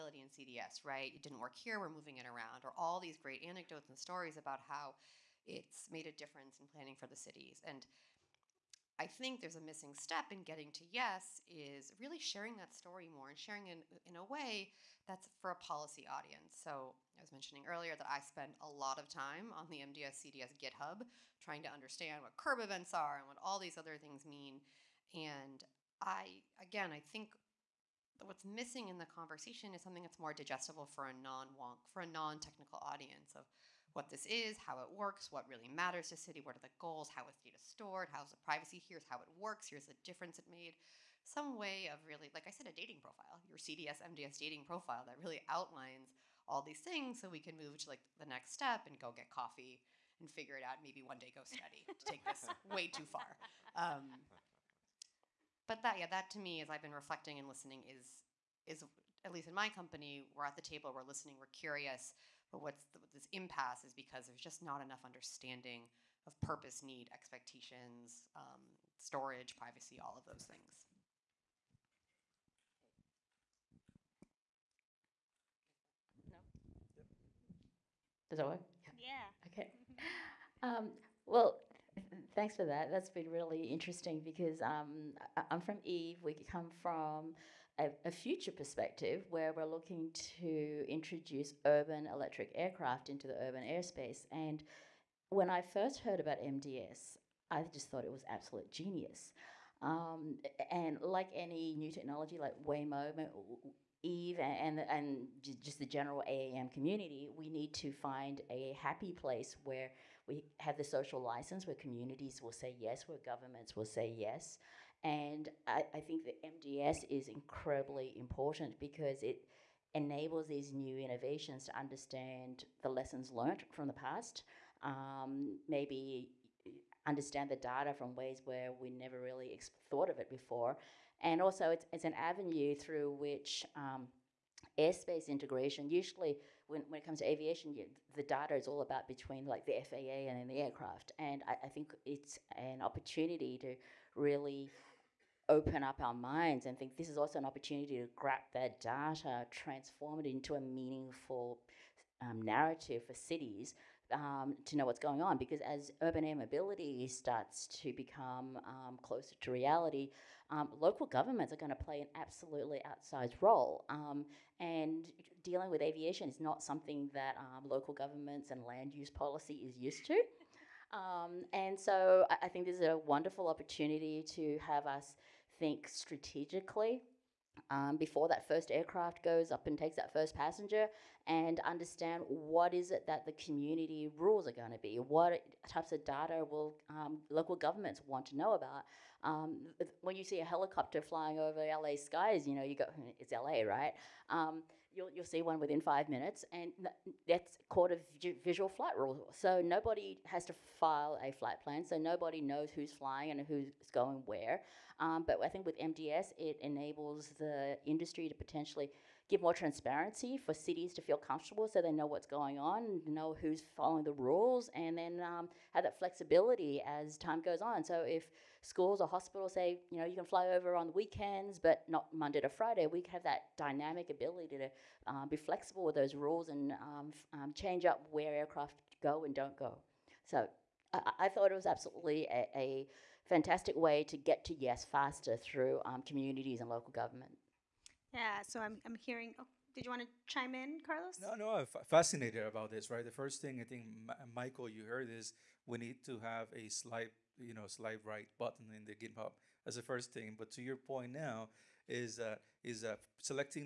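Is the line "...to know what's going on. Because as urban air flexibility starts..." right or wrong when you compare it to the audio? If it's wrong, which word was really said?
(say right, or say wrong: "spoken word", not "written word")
wrong: "mobility", not "flexibility".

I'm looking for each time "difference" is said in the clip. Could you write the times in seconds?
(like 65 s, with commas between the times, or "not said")
6 s, 40 s.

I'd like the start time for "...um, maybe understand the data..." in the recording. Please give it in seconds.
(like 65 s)
124 s.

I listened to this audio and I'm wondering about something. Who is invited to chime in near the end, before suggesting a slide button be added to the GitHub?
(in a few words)
Carlos.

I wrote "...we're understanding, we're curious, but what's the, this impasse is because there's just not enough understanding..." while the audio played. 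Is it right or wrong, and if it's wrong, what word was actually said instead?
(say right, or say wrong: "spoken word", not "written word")
wrong: "listening", not "understanding".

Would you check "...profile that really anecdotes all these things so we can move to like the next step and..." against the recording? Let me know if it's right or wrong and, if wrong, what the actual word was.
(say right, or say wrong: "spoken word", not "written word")
wrong: "outlines", not "anecdotes".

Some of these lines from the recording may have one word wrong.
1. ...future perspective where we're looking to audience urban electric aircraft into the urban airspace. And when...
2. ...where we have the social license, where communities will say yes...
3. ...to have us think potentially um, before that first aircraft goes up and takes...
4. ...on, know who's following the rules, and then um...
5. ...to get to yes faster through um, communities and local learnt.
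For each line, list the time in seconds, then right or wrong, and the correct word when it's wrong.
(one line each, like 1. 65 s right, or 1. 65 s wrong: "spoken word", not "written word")
1. 88 s wrong: "introduce", not "audience"
2. 109 s right
3. 174 s wrong: "strategically", not "potentially"
4. 212 s right
5. 234 s wrong: "government", not "learnt".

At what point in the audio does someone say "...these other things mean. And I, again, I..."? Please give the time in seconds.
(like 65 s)
23 s.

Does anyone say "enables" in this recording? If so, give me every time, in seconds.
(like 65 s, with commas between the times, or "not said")
119 s, 206 s.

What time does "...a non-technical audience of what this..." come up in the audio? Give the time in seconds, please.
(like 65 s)
32 s.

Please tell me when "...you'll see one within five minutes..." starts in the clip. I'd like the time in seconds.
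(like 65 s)
195 s.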